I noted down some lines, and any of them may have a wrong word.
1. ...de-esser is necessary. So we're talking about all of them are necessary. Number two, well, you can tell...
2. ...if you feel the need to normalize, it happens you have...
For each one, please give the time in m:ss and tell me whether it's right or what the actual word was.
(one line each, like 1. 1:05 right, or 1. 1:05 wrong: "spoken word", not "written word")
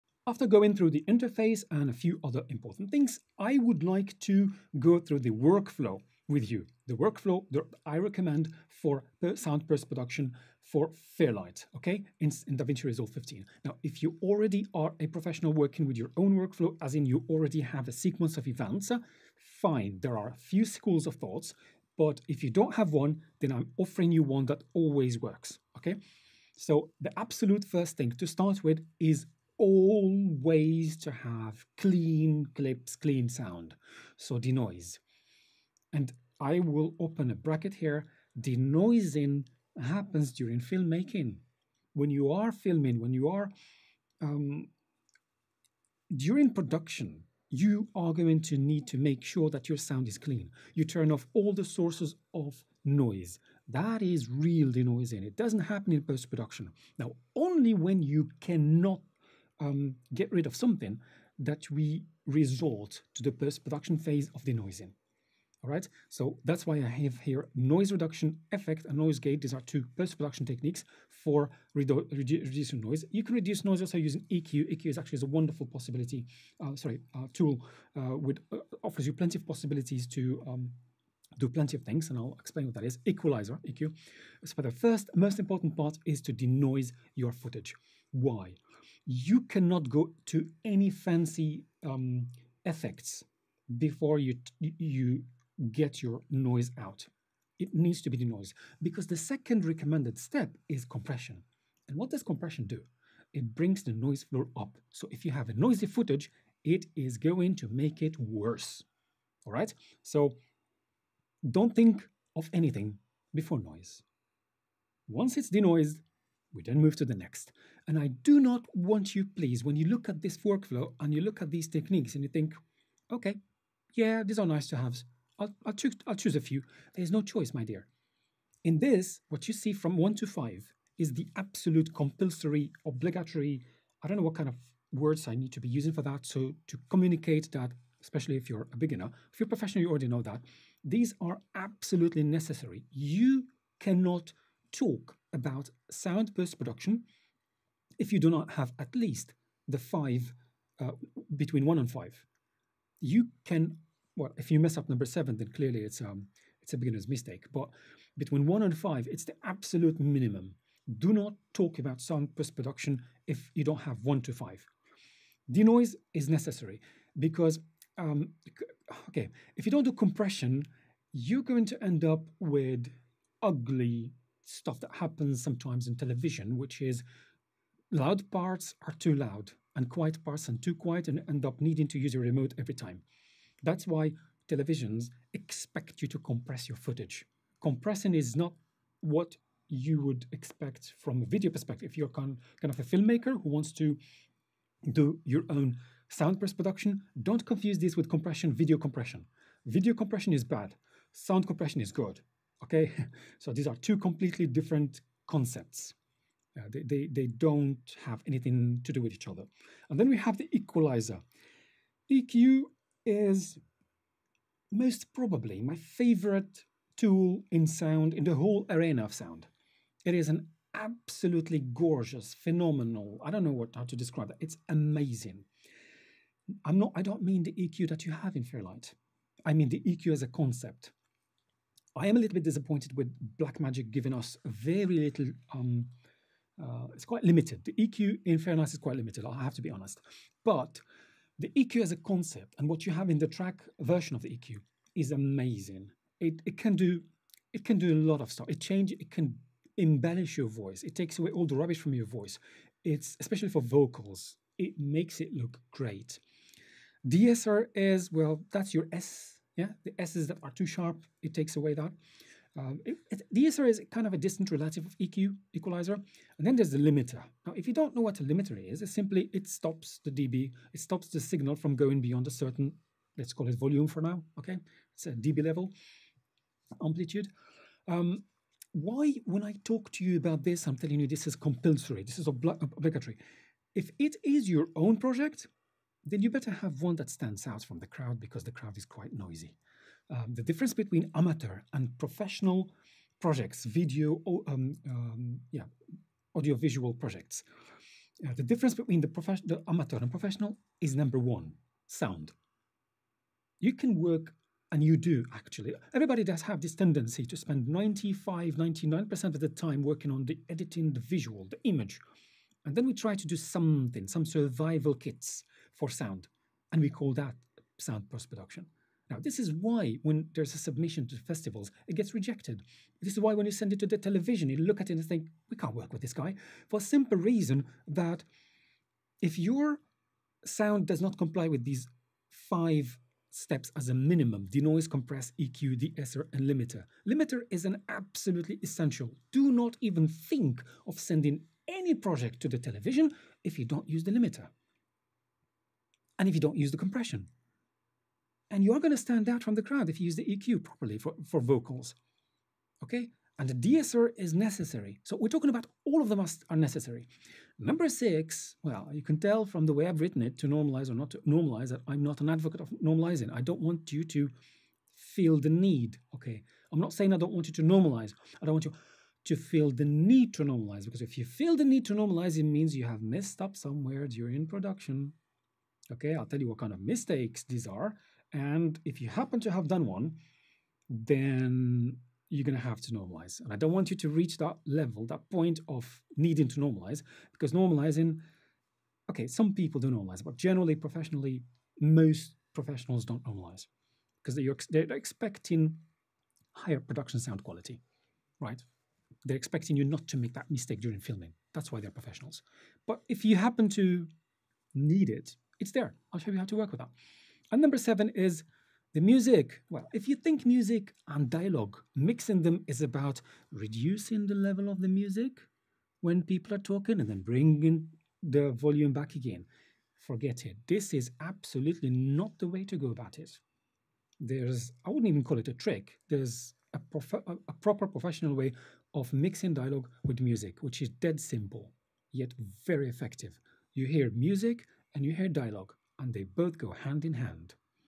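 1. 5:53 wrong: "six", not "two"
2. 6:11 wrong: "means", not "happens".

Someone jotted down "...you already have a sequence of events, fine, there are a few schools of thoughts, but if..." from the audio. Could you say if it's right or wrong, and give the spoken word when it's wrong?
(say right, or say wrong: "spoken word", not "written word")
right.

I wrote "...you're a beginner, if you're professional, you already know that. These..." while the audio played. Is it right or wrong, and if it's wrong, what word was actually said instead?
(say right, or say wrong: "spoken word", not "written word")
right.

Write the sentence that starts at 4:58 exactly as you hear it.
Uh, the difference between the, the amateur and professional is number one, sound.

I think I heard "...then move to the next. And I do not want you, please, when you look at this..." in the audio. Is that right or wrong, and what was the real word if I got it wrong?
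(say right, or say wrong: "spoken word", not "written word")
right.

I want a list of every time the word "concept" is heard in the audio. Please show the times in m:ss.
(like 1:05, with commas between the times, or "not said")
3:25, 3:50, 4:01.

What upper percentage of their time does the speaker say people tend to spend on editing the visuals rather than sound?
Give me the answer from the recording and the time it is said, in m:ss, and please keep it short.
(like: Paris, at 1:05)
99%, at 5:08.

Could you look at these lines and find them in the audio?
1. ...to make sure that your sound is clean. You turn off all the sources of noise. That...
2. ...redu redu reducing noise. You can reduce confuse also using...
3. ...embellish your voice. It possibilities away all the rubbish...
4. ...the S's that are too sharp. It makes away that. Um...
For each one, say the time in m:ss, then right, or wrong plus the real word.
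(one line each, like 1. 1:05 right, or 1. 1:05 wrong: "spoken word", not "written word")
1. 0:48 right
2. 1:11 wrong: "noise", not "confuse"
3. 4:09 wrong: "takes", not "possibilities"
4. 4:19 wrong: "takes", not "makes".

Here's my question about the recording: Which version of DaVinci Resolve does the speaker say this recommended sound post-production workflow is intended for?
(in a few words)
15.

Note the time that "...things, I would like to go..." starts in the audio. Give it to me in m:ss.
0:02.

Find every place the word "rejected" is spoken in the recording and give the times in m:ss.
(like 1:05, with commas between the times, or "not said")
5:22.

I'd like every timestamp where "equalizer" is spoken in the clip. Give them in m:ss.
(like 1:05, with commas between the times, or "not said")
1:23, 3:30, 4:25.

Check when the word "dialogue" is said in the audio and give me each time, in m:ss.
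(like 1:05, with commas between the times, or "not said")
6:51, 7:09, 7:15.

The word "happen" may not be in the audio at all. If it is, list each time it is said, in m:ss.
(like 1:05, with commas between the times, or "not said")
0:39, 0:55, 2:55, 6:19, 6:43.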